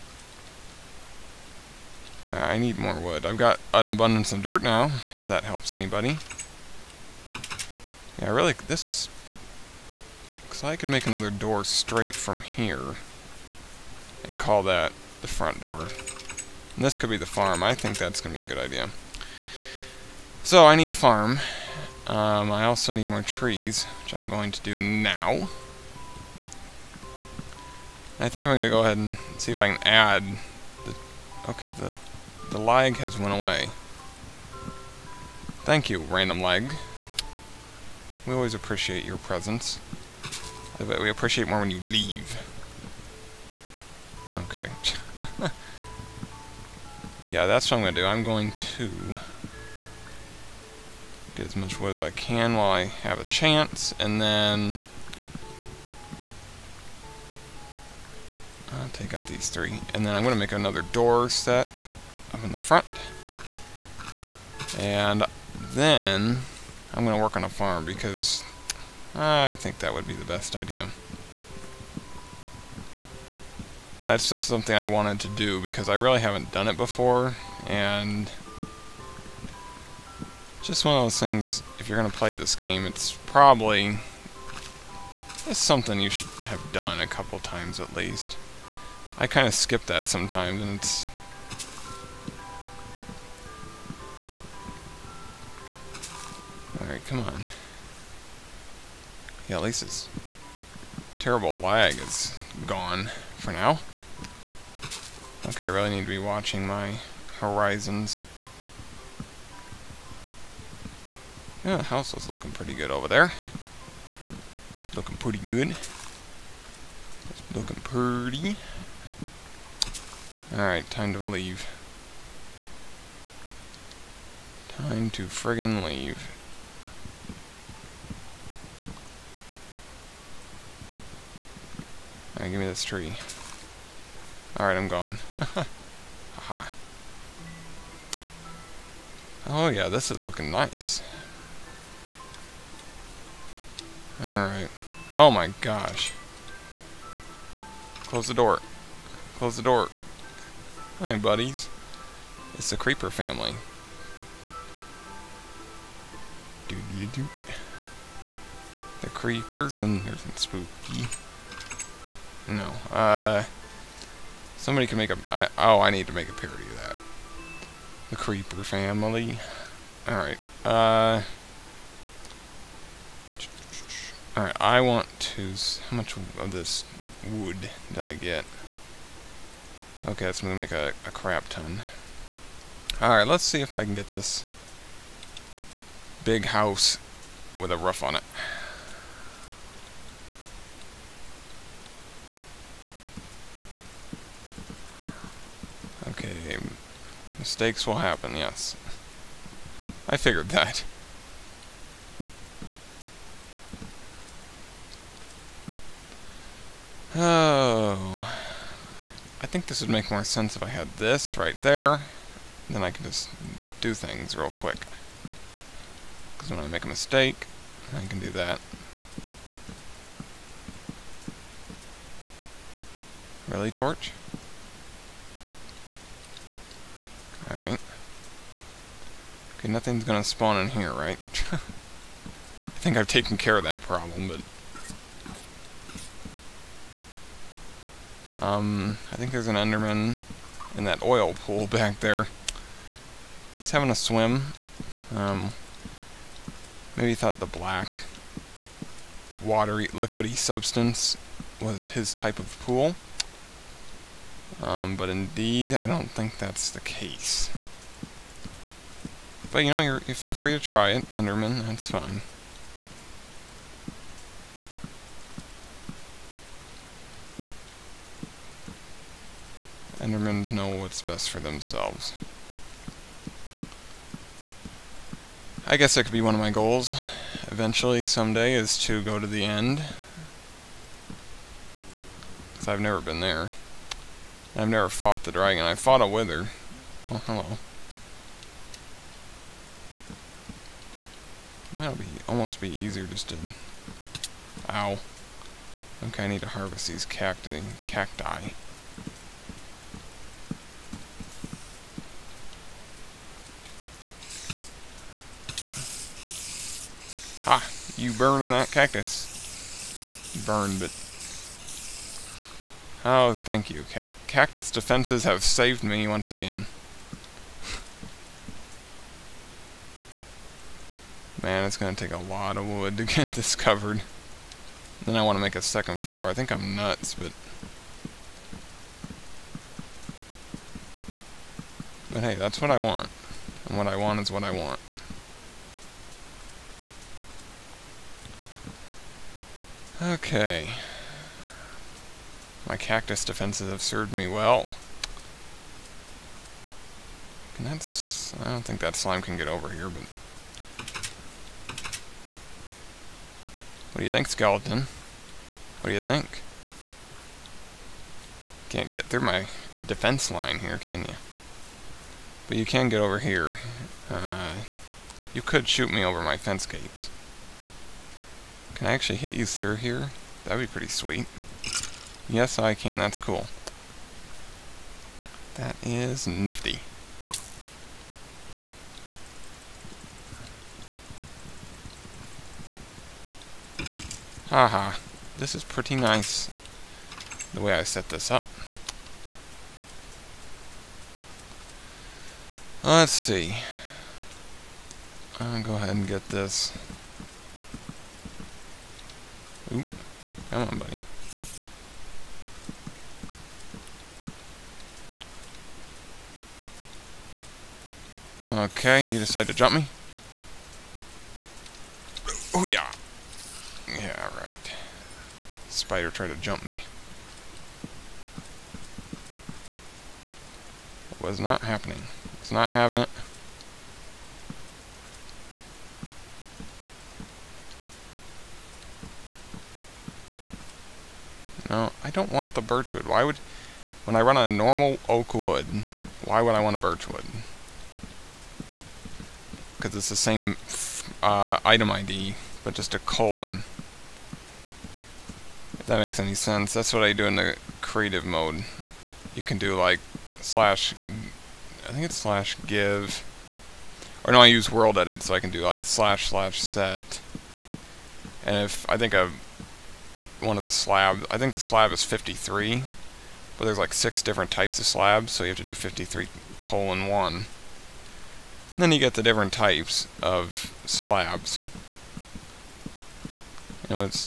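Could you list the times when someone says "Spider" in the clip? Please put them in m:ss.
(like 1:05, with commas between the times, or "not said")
6:55.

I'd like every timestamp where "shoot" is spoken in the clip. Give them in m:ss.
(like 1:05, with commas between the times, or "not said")
6:05.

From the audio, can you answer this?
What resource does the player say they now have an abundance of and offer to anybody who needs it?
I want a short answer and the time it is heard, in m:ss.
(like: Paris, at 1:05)
Dirt, at 0:04.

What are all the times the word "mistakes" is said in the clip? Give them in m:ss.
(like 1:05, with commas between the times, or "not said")
3:17, 3:36.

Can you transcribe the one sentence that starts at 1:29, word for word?
I kind of skip that sometimes, and it's...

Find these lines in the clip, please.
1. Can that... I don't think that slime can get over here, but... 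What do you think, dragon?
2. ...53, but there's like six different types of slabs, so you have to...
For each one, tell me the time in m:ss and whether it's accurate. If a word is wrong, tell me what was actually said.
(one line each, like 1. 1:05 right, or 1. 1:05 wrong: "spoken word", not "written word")
1. 5:47 wrong: "skeleton", not "dragon"
2. 7:42 right.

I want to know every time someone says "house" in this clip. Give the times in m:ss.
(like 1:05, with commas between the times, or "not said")
1:51, 3:06.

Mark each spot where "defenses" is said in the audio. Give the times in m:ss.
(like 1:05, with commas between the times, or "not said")
5:14, 5:43, 5:59.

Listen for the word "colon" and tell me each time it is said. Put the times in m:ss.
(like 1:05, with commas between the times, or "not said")
7:22, 7:46.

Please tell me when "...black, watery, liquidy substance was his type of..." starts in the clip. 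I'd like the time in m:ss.
4:07.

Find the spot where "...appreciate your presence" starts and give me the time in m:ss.
0:38.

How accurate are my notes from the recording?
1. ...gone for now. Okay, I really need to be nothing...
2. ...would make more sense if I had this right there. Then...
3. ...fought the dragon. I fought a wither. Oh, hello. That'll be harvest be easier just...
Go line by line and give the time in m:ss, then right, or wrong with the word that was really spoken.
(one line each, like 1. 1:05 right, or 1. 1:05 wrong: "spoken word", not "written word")
1. 1:42 wrong: "watching", not "nothing"
2. 3:29 right
3. 4:44 wrong: "almost", not "harvest".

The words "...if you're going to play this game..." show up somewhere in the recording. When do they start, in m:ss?
1:21.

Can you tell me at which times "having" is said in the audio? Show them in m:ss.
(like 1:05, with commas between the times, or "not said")
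4:03, 7:02.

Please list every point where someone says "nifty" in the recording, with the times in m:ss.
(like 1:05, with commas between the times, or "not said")
6:16.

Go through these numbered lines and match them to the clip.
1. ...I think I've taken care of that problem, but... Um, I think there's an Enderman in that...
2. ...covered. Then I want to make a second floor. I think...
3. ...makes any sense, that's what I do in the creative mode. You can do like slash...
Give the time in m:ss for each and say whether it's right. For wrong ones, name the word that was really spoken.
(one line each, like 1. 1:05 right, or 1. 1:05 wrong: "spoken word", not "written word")
1. 3:51 right
2. 5:23 right
3. 7:25 right.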